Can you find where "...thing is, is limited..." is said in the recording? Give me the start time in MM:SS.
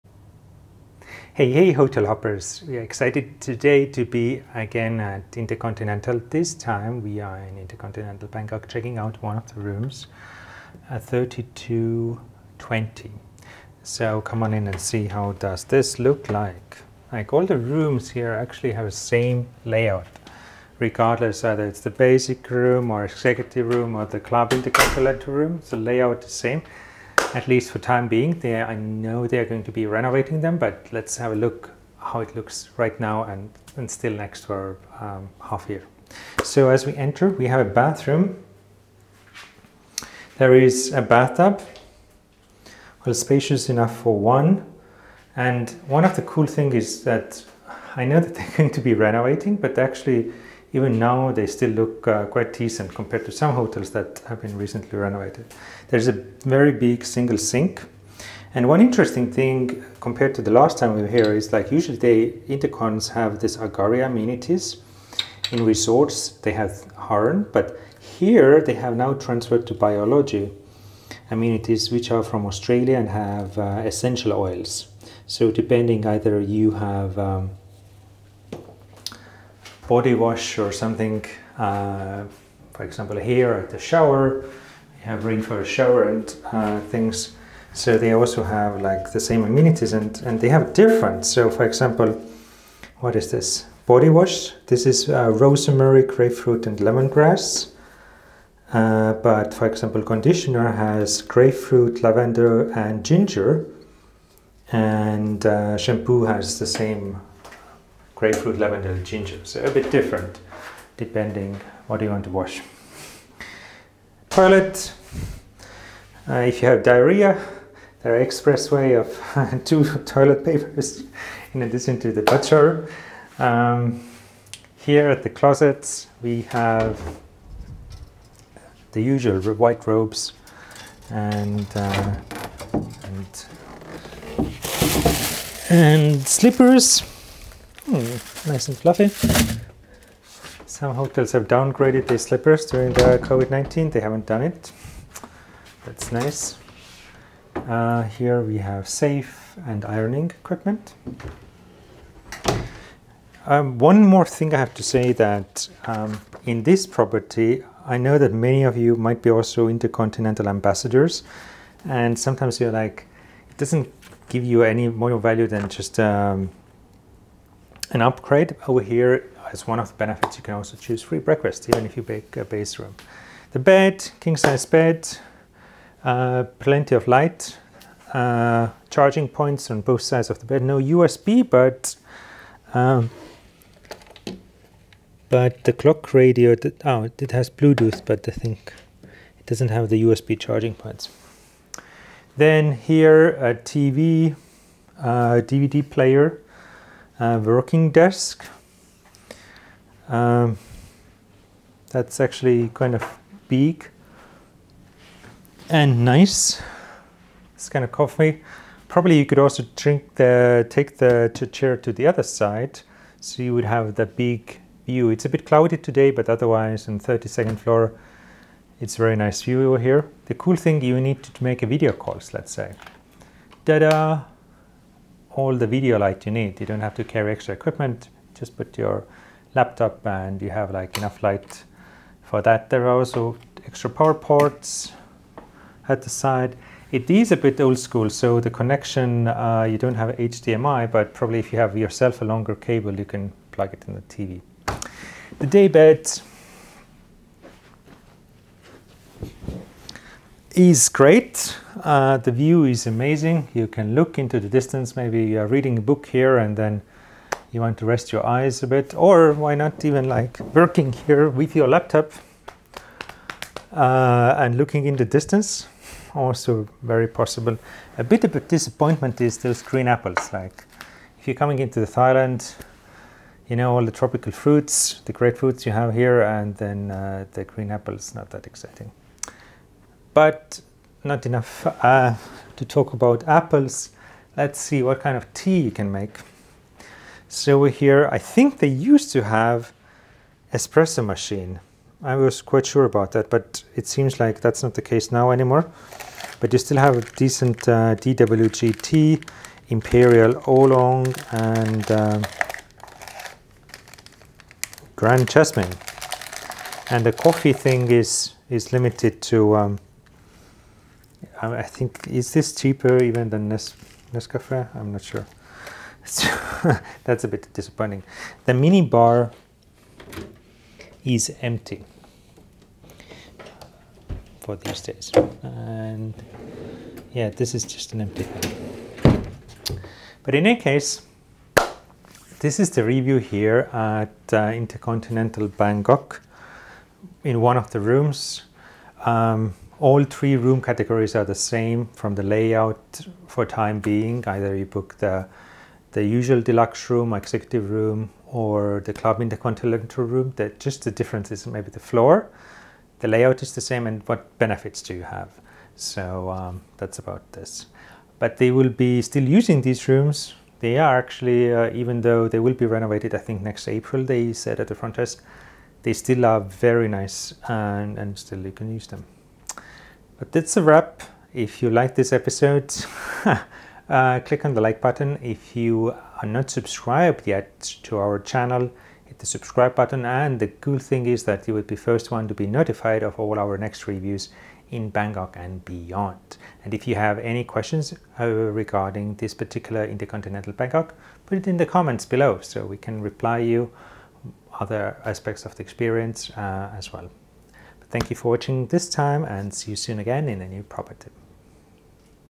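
05:07.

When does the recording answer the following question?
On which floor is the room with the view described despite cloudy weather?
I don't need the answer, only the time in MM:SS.
03:36.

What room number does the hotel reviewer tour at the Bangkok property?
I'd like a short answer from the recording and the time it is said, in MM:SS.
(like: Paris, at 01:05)
3220, at 00:11.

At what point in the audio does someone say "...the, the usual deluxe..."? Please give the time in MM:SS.
05:44.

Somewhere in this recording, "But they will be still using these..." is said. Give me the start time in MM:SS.
05:58.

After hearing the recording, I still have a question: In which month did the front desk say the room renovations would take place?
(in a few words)
April.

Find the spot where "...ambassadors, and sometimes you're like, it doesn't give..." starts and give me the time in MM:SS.
02:40.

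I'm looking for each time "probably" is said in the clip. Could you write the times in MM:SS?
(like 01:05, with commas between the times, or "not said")
03:28, 04:01.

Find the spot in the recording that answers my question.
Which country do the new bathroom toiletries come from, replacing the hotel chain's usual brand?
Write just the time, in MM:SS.
01:12.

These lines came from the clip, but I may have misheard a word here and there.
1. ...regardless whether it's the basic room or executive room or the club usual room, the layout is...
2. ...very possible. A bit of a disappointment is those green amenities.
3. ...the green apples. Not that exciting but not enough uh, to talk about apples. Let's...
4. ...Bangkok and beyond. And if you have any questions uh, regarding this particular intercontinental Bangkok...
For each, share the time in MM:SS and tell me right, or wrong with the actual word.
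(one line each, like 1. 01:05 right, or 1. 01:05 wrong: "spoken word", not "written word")
1. 00:20 wrong: "intercontinental", not "usual"
2. 04:26 wrong: "apples", not "amenities"
3. 04:37 right
4. 06:24 right.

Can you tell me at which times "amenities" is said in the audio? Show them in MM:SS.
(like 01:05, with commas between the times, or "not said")
01:04, 01:11, 01:29.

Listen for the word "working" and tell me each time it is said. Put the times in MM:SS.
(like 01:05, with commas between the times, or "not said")
03:17, 04:20.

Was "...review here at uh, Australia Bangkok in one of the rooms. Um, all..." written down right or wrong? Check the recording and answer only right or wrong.
wrong.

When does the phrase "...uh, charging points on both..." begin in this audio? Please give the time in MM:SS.
02:58.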